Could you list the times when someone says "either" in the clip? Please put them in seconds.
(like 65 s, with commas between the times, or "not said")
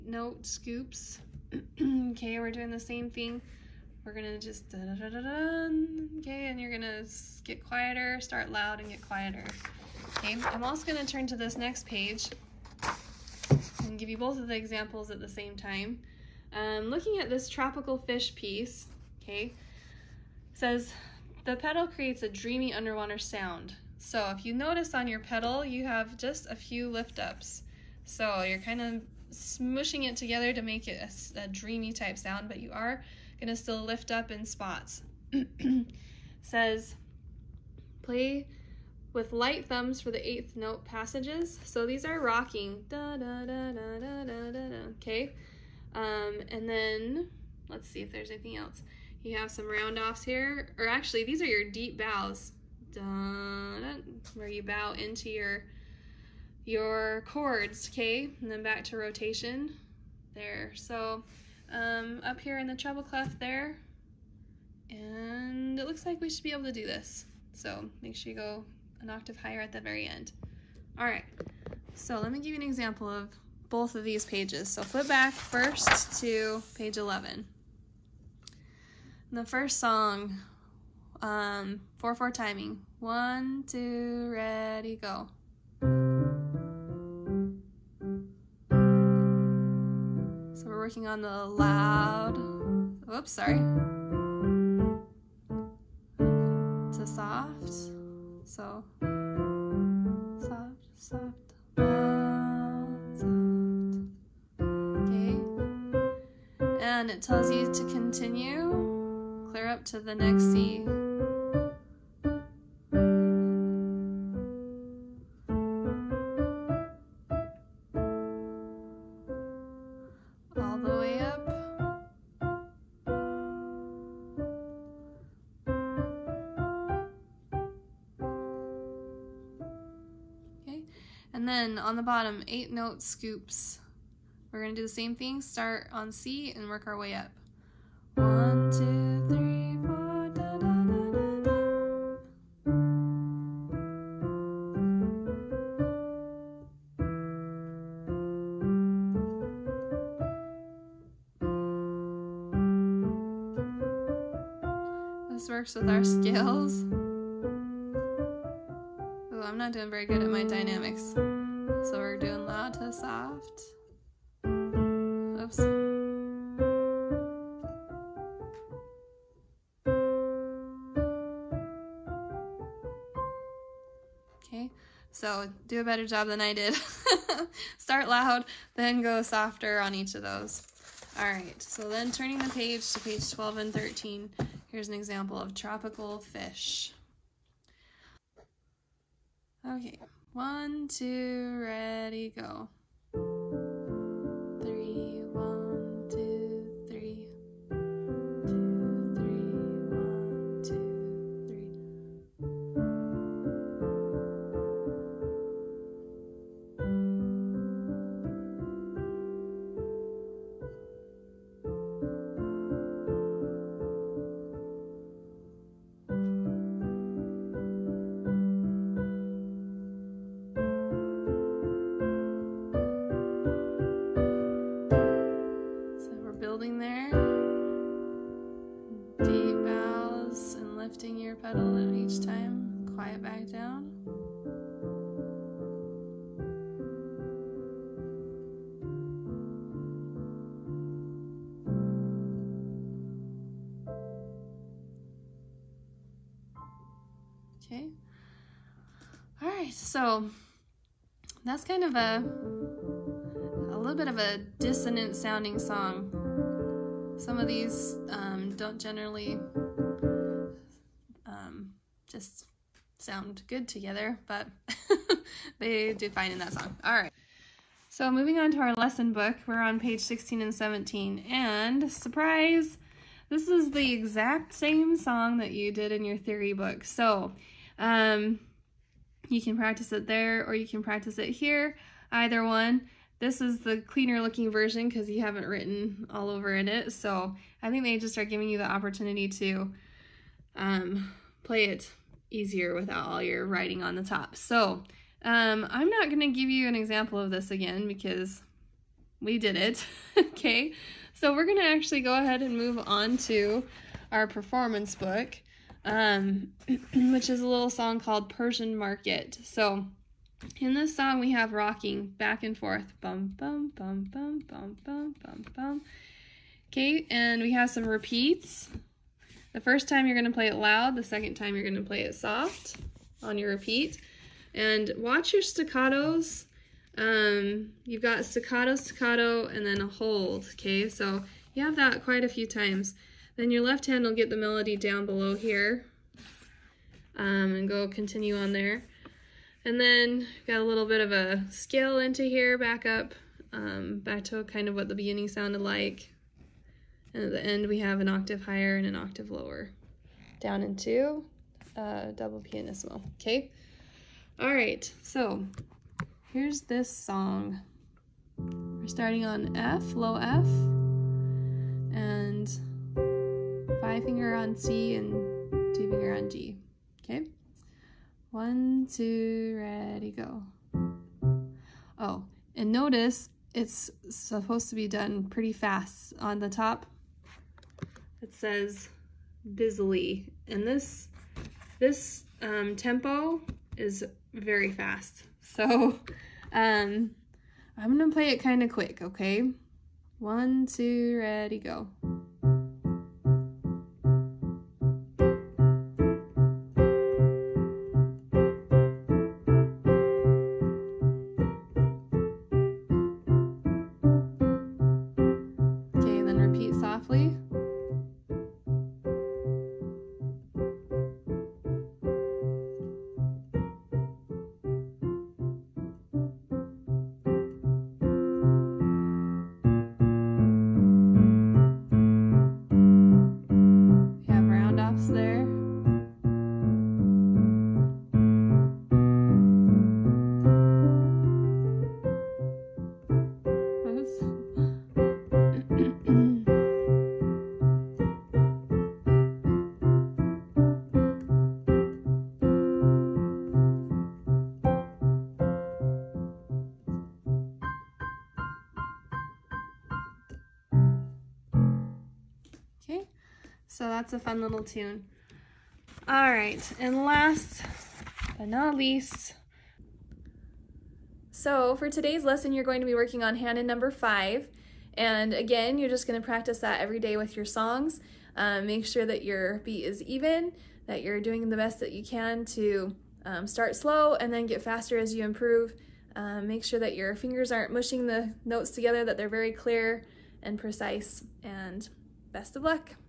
282 s.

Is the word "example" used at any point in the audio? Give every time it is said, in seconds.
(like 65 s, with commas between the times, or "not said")
14 s, 72 s, 184 s, 296 s.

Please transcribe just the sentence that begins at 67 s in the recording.
So make sure you go an octave higher at the very end.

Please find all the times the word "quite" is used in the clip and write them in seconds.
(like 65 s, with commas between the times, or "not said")
332 s.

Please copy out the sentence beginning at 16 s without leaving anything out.
Um, looking at this tropical fish piece, okay, says the pedal creates a dreamy underwater sound.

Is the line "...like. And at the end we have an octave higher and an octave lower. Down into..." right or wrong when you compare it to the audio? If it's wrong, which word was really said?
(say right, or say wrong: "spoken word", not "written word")
right.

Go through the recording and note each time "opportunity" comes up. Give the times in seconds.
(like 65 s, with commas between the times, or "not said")
288 s.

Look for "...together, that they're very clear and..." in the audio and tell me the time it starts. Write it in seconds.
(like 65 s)
478 s.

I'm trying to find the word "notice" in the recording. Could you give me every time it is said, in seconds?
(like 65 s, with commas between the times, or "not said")
24 s, 372 s.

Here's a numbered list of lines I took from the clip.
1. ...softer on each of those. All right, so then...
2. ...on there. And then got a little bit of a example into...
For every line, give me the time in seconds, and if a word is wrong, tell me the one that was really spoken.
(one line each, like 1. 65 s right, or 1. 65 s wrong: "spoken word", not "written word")
1. 179 s right
2. 338 s wrong: "scale", not "example".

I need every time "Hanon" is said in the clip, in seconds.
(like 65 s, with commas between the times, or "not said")
463 s.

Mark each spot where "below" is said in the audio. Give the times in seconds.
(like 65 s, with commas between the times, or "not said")
335 s.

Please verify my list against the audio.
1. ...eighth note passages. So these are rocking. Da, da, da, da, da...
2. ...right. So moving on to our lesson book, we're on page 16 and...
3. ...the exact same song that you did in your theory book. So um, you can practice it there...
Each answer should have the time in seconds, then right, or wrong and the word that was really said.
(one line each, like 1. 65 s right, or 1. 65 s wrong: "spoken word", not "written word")
1. 40 s right
2. 266 s right
3. 273 s right.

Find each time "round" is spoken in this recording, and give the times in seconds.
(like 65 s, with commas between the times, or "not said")
49 s.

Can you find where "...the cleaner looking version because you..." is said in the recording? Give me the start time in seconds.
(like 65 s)
283 s.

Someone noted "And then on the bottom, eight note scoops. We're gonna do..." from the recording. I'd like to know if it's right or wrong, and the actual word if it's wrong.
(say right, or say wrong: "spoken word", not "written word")
right.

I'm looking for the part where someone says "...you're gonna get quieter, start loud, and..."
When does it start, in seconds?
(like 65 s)
6 s.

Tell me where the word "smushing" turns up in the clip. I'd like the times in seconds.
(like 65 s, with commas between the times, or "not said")
29 s.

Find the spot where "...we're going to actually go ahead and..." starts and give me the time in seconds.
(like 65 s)
301 s.